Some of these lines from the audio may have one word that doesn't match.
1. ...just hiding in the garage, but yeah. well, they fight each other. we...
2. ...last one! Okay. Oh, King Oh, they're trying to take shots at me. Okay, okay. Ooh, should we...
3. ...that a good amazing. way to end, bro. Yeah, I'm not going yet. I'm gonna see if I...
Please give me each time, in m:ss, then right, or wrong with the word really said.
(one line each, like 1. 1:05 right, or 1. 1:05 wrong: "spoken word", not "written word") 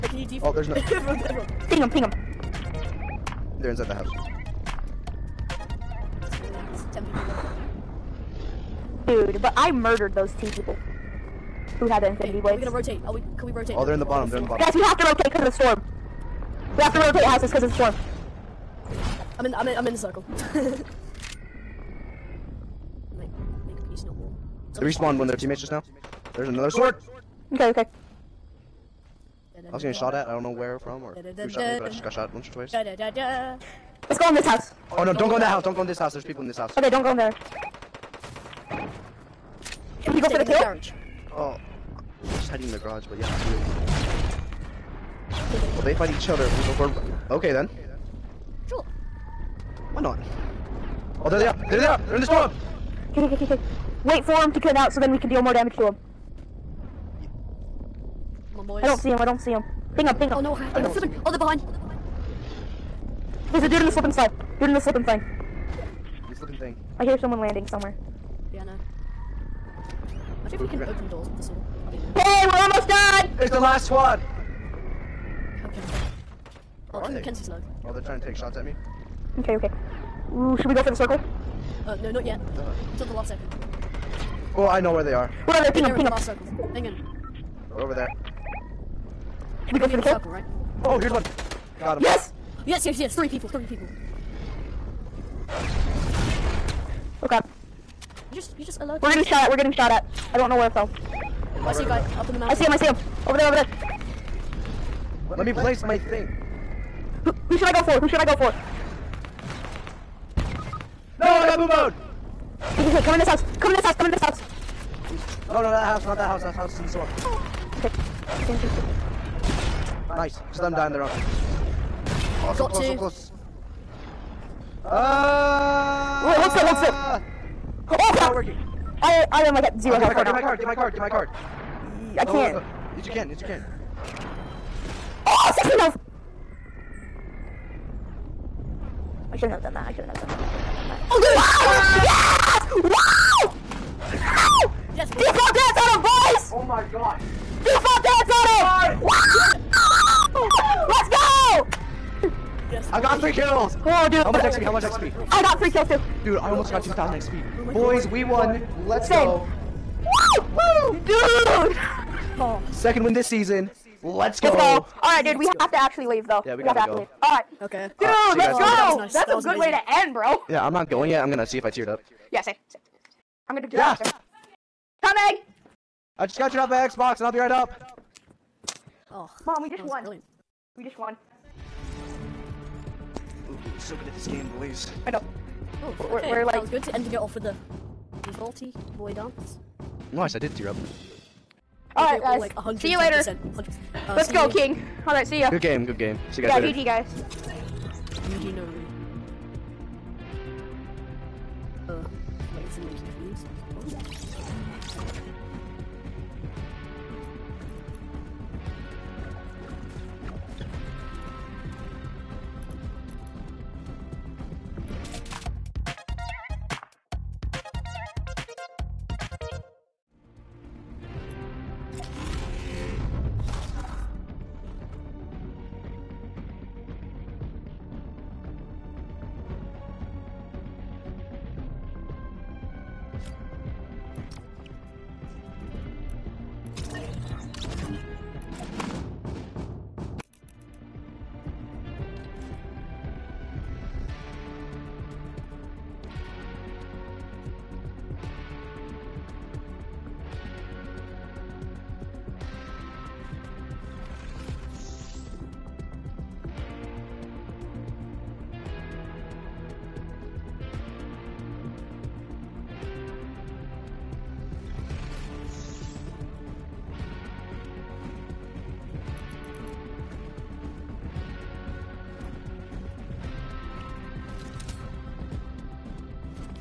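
1. 0:42 right
2. 1:13 right
3. 2:49 right.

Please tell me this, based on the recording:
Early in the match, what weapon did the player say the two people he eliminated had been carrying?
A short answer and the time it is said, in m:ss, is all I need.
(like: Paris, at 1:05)
Infinity Blades, at 0:12.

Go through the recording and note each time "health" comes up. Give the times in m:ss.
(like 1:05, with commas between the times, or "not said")
2:09, 2:15.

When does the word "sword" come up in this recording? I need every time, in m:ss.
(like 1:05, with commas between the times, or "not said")
0:26, 1:11.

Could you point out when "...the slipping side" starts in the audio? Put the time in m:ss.
1:03.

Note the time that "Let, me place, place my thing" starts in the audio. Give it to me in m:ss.
1:45.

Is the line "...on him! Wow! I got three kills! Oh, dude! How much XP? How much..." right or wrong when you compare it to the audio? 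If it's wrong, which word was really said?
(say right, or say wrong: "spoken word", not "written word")
right.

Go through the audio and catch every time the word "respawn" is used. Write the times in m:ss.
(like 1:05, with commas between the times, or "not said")
0:24.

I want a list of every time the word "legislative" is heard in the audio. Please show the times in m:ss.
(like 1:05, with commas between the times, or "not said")
not said.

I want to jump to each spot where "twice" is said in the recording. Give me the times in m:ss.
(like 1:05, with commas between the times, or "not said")
0:32.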